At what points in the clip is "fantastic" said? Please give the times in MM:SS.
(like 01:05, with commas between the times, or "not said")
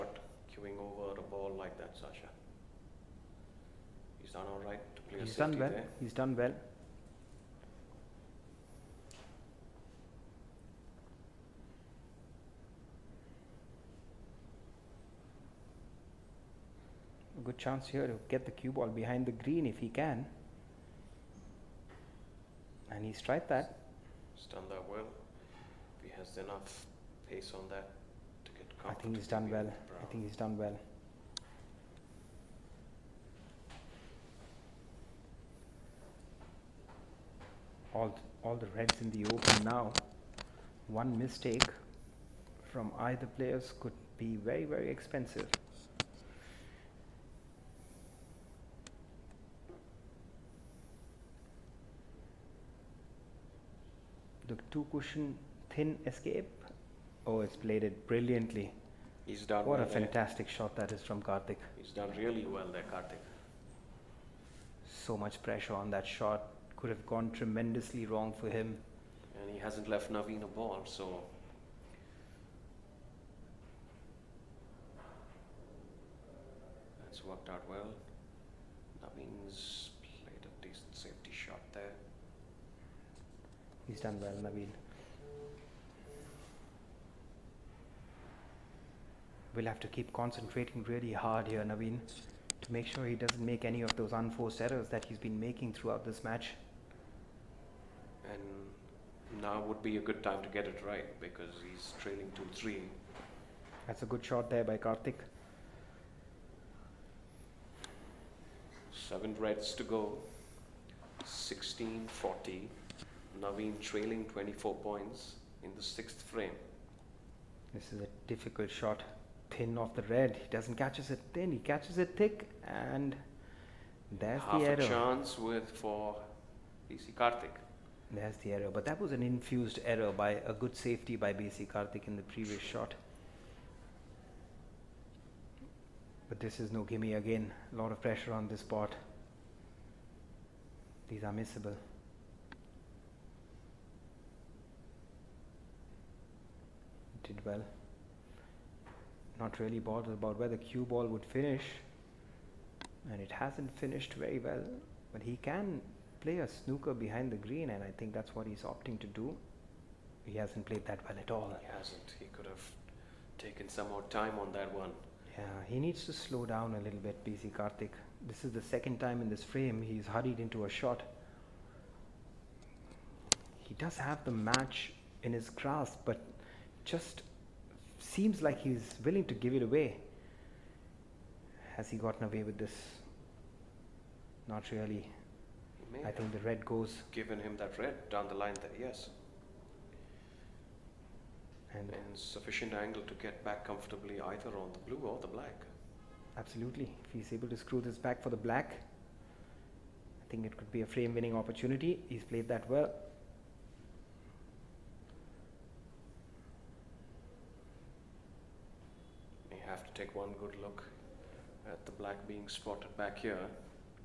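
00:59.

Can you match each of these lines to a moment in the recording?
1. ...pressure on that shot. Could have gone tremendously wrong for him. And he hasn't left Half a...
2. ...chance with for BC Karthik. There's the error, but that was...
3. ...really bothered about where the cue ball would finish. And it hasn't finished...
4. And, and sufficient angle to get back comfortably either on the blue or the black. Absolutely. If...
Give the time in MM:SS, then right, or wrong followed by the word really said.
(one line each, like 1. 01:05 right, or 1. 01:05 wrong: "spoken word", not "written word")
1. 01:05 wrong: "Naveen", not "Half"
2. 02:04 right
3. 02:29 right
4. 03:11 right.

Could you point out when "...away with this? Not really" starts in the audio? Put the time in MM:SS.
03:02.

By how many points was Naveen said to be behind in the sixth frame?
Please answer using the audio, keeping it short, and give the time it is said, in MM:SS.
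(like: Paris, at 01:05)
24, at 01:54.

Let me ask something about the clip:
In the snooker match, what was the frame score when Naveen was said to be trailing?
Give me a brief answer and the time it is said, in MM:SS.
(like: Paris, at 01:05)
2-3, at 01:42.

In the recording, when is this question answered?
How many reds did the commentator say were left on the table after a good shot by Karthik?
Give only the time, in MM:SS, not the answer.
01:48.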